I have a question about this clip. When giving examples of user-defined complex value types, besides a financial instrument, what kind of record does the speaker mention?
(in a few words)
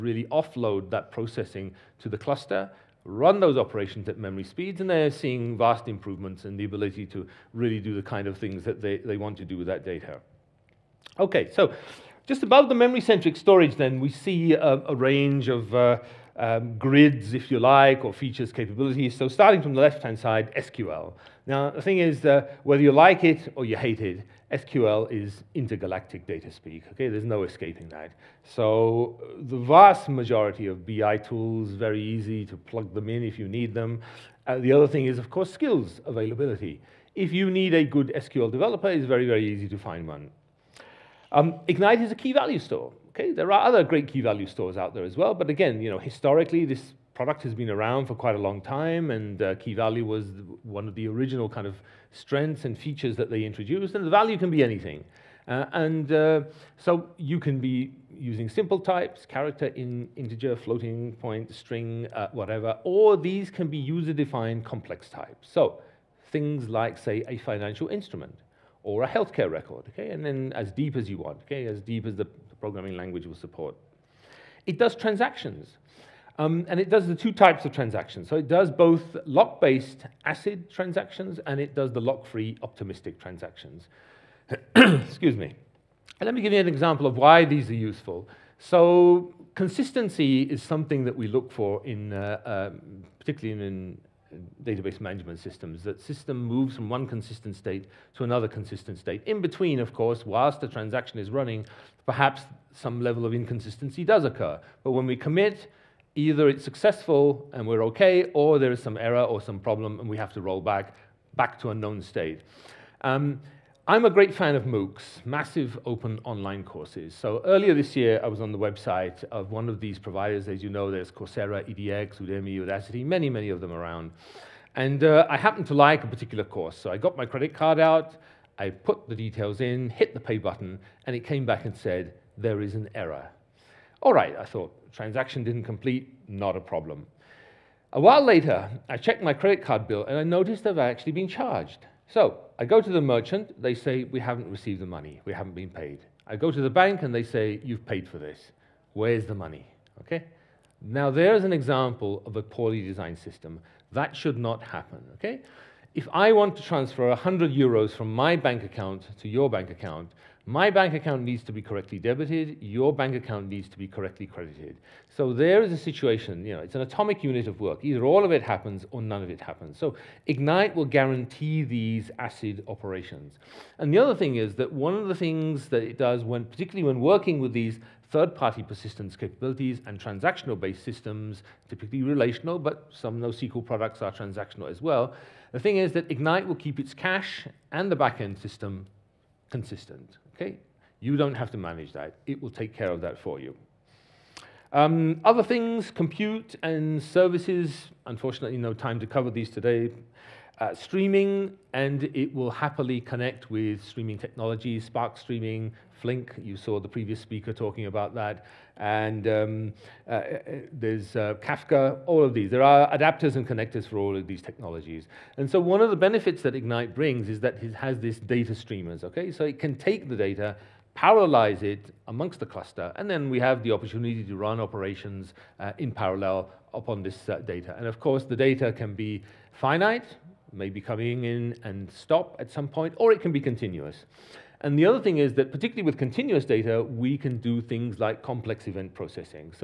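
healthcare record.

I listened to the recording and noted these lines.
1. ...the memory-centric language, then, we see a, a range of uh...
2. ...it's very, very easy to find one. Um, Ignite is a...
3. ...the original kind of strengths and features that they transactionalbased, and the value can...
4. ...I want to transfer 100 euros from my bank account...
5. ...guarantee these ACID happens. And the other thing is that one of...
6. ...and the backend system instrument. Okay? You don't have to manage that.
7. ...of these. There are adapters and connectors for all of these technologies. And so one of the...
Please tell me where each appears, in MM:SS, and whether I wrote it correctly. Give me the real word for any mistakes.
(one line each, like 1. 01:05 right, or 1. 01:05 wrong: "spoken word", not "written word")
1. 00:12 wrong: "storage", not "language"
2. 00:38 right
3. 00:50 wrong: "introduced", not "transactionalbased"
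4. 02:36 right
5. 02:50 wrong: "operations", not "happens"
6. 03:07 wrong: "consistent", not "instrument"
7. 03:32 right.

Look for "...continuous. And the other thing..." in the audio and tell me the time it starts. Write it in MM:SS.
03:53.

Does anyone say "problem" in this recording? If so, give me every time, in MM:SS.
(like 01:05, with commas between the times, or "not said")
01:49, 02:16.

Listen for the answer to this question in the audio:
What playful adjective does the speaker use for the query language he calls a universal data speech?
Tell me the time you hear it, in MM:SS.
00:25.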